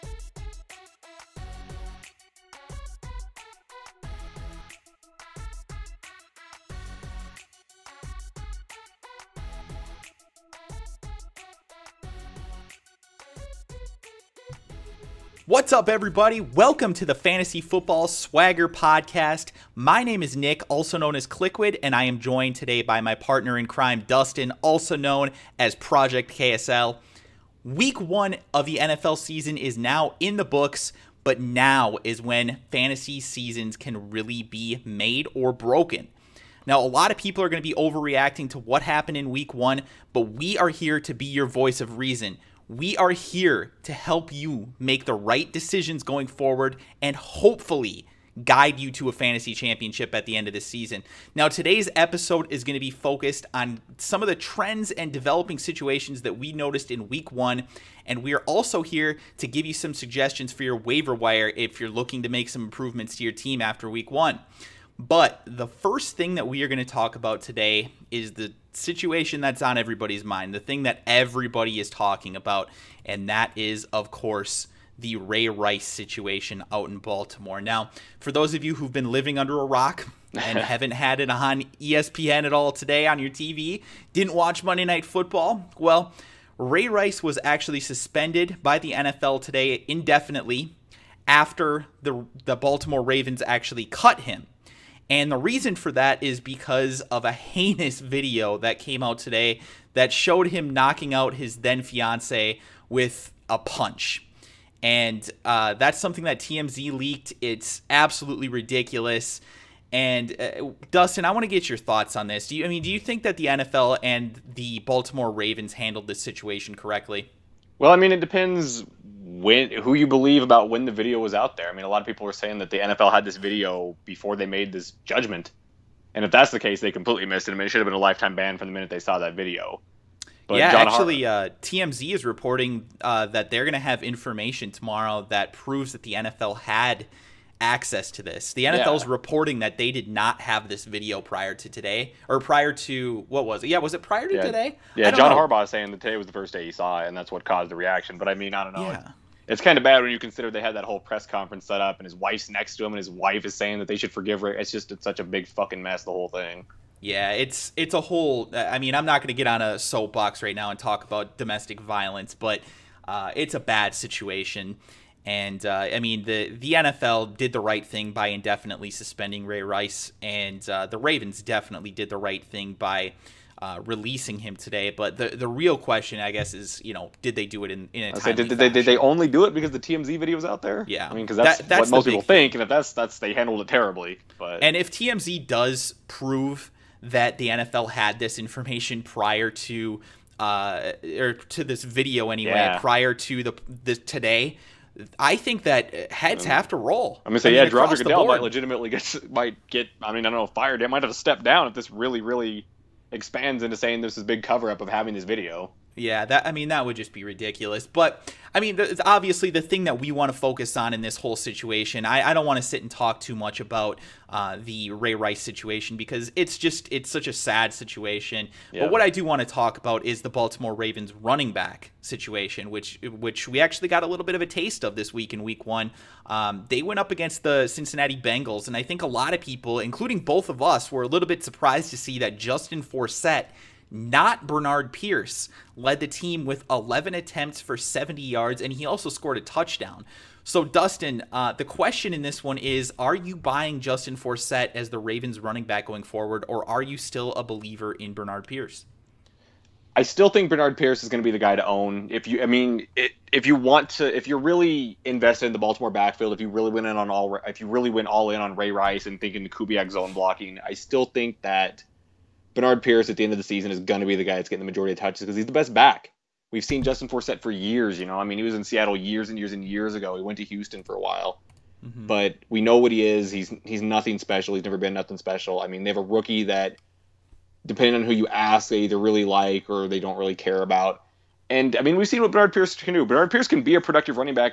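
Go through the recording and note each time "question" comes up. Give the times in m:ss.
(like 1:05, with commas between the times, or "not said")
2:55, 4:01.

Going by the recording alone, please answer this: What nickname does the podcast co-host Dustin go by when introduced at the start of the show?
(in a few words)
Project KSL.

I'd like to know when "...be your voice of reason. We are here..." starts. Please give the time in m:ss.
0:41.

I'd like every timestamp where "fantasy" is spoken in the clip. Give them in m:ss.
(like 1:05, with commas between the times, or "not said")
0:17, 0:32, 0:49.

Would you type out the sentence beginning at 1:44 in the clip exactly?
And uh, that's something that TMZ leaked.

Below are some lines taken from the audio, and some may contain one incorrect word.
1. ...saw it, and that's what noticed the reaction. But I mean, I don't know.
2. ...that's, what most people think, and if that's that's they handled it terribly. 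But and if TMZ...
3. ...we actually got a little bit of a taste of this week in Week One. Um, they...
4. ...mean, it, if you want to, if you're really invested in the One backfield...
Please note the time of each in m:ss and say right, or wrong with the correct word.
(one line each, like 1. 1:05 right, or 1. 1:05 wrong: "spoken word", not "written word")
1. 2:26 wrong: "caused", not "noticed"
2. 3:01 right
3. 3:43 right
4. 4:12 wrong: "Baltimore", not "One".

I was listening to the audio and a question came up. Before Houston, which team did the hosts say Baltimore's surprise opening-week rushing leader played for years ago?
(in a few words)
Seattle.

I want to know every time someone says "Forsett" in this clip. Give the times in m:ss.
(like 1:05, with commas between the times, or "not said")
3:52, 4:04, 4:27.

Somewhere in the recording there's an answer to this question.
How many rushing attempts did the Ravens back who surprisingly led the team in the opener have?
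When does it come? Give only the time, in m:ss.
3:56.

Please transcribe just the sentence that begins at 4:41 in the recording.
And I mean, we've seen what Bernard Pierce can do.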